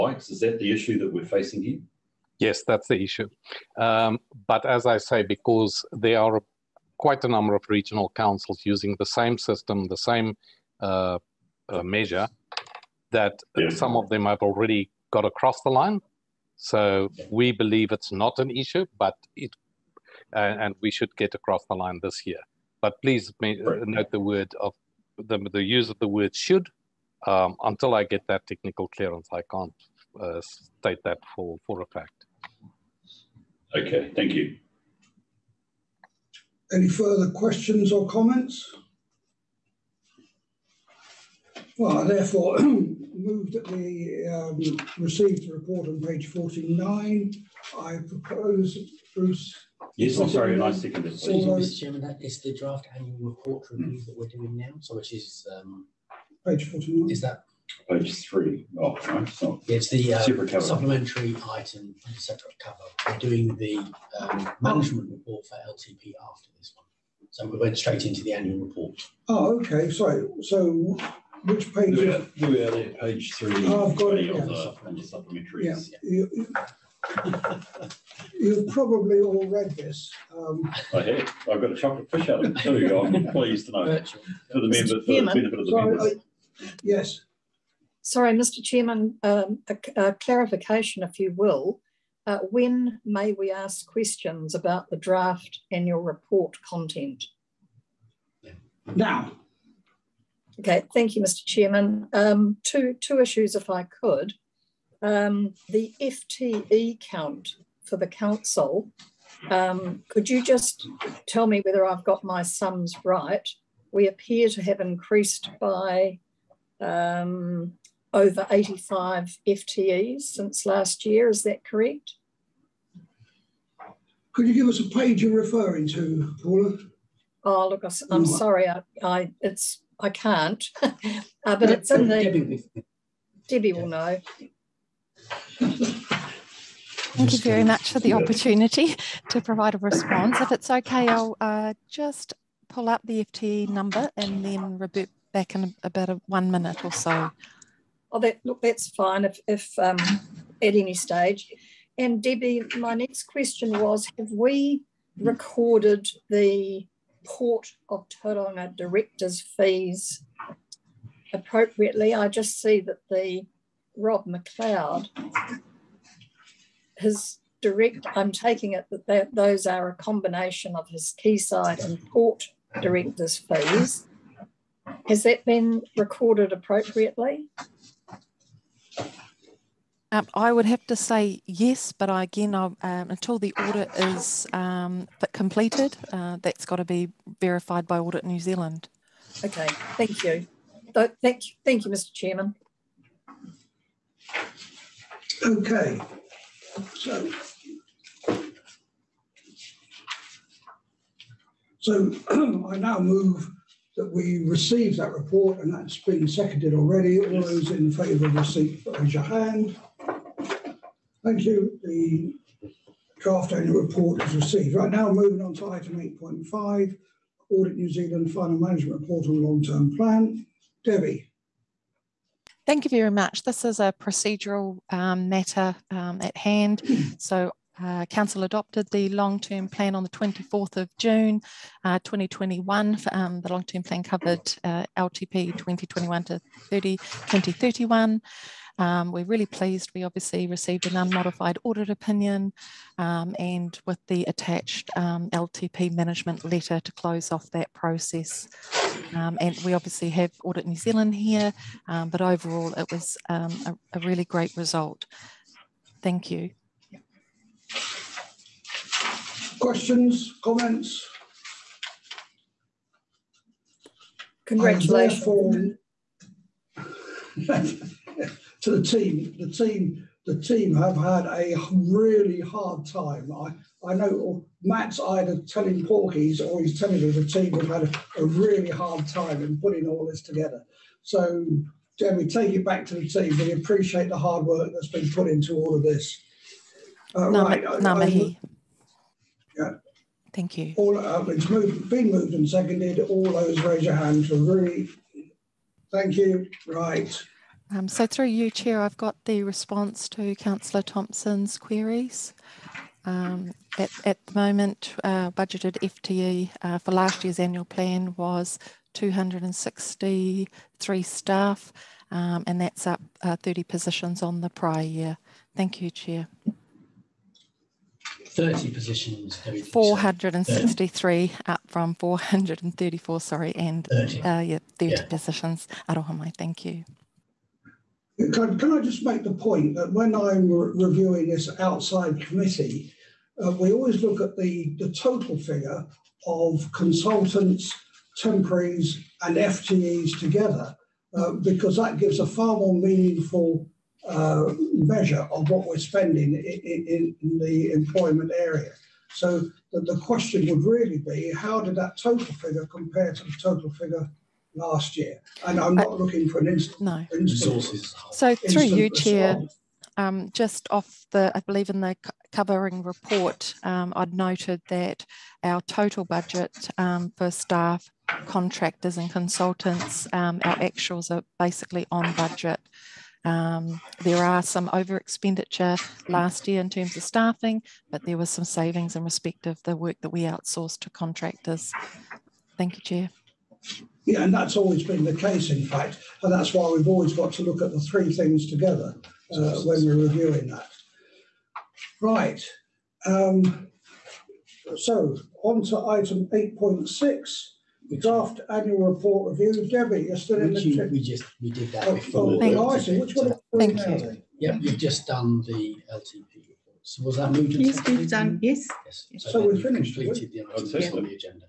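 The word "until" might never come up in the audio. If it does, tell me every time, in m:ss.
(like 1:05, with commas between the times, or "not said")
0:27, 3:02.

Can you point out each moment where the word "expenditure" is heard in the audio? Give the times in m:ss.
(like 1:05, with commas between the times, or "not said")
6:14.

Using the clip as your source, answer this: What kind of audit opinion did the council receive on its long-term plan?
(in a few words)
unmodified.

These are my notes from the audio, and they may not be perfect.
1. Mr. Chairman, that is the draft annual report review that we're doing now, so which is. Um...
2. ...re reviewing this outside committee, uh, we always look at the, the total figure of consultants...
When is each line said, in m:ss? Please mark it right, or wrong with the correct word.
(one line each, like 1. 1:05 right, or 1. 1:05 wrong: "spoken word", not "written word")
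1. 0:51 right
2. 5:30 right.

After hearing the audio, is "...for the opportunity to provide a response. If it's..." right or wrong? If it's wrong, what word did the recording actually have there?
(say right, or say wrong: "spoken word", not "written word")
right.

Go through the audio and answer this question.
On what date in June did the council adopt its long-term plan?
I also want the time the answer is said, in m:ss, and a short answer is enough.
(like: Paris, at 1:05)
24th of June, at 3:50.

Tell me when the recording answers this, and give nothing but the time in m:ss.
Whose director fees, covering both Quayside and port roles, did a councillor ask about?
2:43.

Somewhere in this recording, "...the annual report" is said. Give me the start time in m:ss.
1:08.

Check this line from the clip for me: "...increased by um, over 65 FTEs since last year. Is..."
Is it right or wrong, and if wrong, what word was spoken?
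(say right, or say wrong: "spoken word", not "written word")
wrong: "85", not "65".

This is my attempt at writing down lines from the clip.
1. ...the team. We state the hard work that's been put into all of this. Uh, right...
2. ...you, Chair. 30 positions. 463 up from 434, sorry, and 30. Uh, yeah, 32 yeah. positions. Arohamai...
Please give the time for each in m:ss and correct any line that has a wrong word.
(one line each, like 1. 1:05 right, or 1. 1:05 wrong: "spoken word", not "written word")
1. 4:42 wrong: "appreciate", not "state"
2. 5:15 wrong: "30", not "32".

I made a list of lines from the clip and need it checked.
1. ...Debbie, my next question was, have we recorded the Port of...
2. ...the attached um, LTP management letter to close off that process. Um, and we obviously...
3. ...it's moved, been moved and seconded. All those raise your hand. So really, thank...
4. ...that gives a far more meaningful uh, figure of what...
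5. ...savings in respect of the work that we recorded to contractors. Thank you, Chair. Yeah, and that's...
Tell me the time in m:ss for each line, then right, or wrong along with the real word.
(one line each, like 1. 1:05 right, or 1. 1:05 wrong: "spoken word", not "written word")
1. 2:32 right
2. 4:04 right
3. 4:51 right
4. 5:41 wrong: "measure", not "figure"
5. 6:18 wrong: "outsourced", not "recorded".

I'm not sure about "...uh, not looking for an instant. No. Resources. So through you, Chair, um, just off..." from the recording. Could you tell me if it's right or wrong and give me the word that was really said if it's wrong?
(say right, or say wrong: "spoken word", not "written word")
right.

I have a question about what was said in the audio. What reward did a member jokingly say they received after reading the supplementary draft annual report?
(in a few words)
a chocolate fish.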